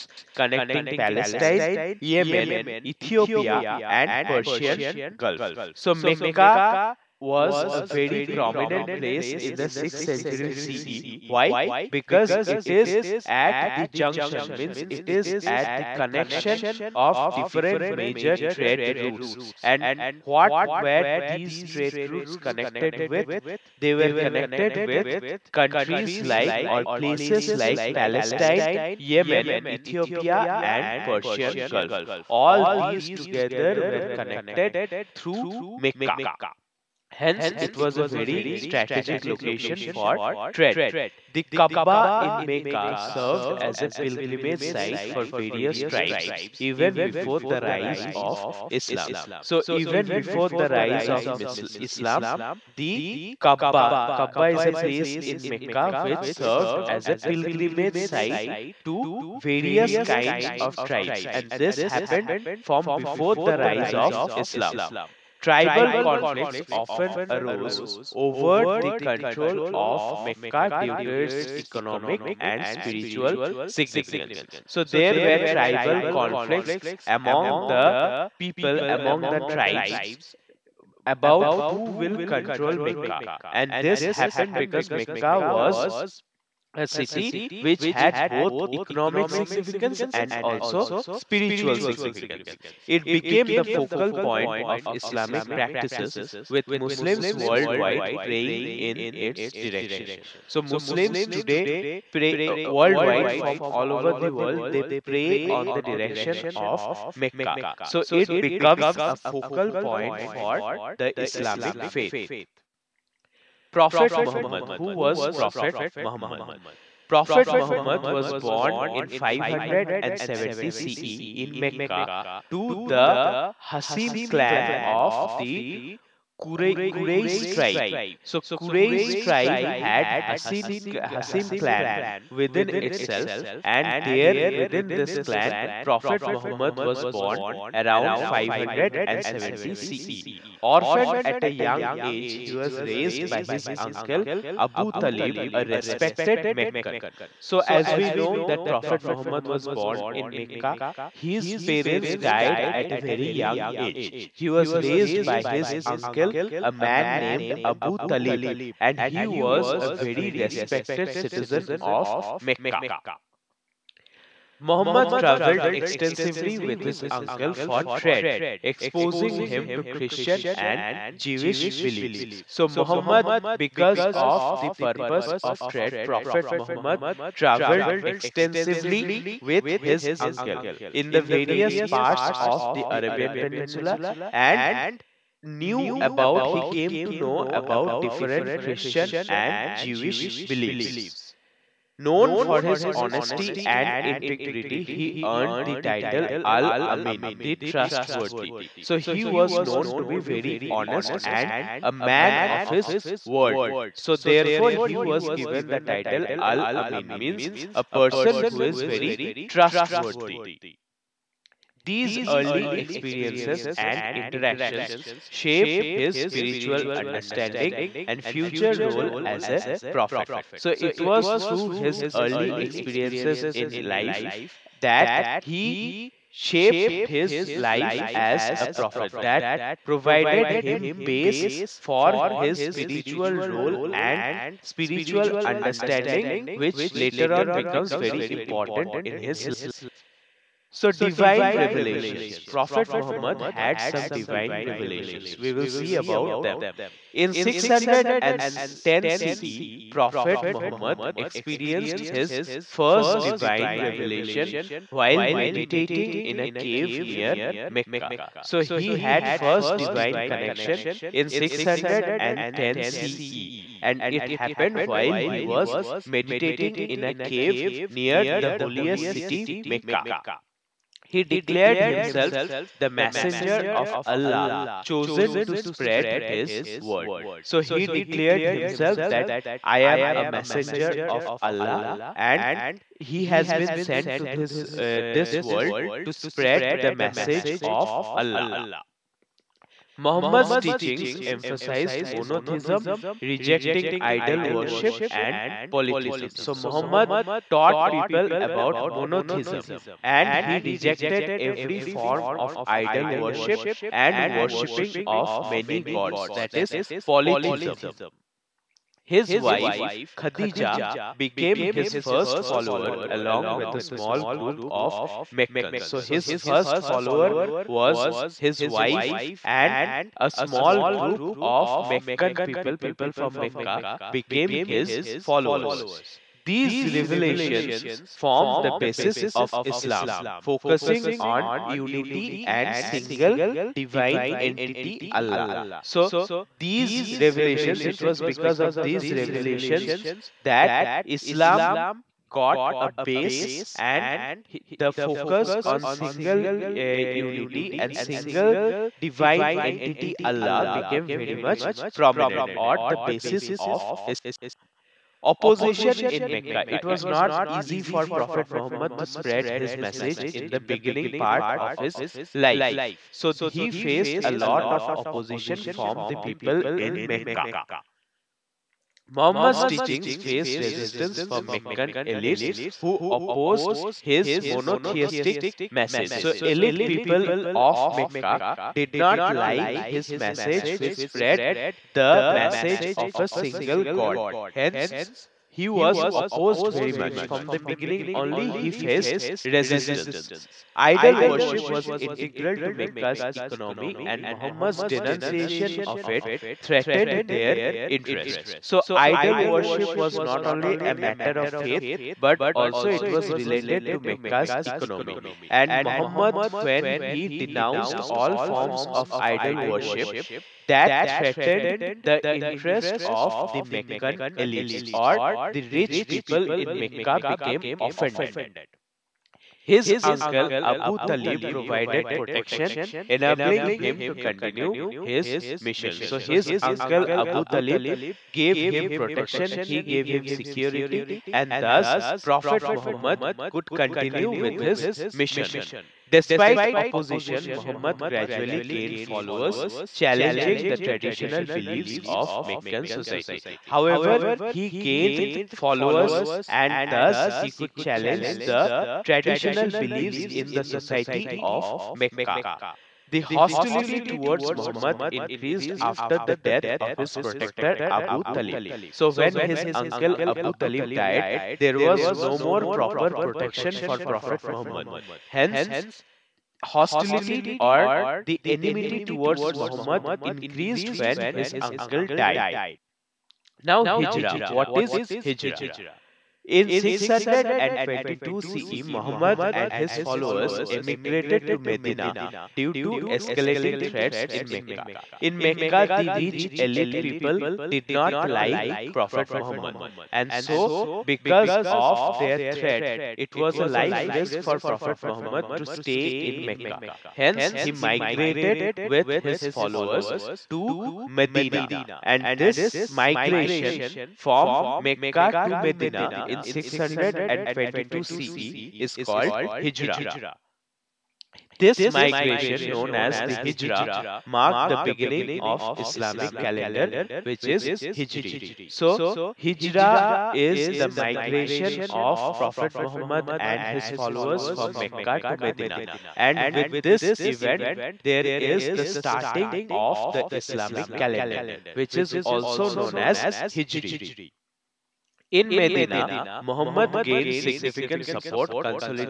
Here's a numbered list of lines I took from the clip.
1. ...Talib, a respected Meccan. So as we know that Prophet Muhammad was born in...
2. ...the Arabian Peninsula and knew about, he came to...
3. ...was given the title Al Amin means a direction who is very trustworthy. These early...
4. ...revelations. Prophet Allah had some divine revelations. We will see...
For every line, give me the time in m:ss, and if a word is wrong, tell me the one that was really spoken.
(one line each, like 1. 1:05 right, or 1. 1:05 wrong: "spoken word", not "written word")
1. 2:24 right
2. 3:02 right
3. 3:24 wrong: "person", not "direction"
4. 4:01 wrong: "Muhammad", not "Allah".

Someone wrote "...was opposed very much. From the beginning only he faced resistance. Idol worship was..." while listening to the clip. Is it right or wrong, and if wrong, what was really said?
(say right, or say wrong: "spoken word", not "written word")
right.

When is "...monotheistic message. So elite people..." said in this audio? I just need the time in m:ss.
6:14.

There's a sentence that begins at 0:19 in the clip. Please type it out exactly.
And what were these trade routes connected with?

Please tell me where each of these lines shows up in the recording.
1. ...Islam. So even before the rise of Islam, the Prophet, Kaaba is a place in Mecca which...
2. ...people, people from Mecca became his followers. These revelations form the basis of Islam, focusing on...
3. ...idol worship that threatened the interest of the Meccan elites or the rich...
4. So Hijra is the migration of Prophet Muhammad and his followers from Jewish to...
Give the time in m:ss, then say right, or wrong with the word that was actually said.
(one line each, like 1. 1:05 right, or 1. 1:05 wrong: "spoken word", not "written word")
1. 0:48 wrong: "Kaaba", not "Prophet"
2. 5:22 right
3. 6:49 right
4. 8:38 wrong: "Mecca", not "Jewish".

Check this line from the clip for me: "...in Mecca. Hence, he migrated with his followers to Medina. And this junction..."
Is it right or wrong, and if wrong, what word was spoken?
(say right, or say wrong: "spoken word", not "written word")
wrong: "migration", not "junction".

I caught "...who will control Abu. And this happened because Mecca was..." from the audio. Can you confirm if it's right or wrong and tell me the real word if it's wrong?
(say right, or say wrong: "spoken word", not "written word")
wrong: "Mecca", not "Abu".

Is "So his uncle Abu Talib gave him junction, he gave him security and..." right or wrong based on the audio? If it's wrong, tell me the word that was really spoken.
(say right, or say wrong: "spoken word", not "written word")
wrong: "protection", not "junction".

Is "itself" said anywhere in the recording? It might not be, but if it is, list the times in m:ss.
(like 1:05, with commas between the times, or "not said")
2:12.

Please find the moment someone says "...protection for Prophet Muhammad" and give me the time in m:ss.
7:43.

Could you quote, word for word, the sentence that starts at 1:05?
Tribal conflicts often arose over the control of Mecca due to its economic and spiritual significance.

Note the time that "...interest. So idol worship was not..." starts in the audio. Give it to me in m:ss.
6:37.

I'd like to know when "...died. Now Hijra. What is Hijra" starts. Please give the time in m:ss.
7:52.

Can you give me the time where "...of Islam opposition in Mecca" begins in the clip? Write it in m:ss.
5:53.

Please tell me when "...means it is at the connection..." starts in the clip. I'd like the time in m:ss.
0:14.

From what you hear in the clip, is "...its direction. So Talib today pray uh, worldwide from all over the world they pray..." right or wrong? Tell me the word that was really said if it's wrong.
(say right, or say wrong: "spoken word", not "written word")
wrong: "Muslims", not "Talib".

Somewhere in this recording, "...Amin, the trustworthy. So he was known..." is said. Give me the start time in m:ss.
3:16.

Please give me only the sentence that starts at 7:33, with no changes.
The hostility towards Muhammad increased after the death of his protector Abu Talib.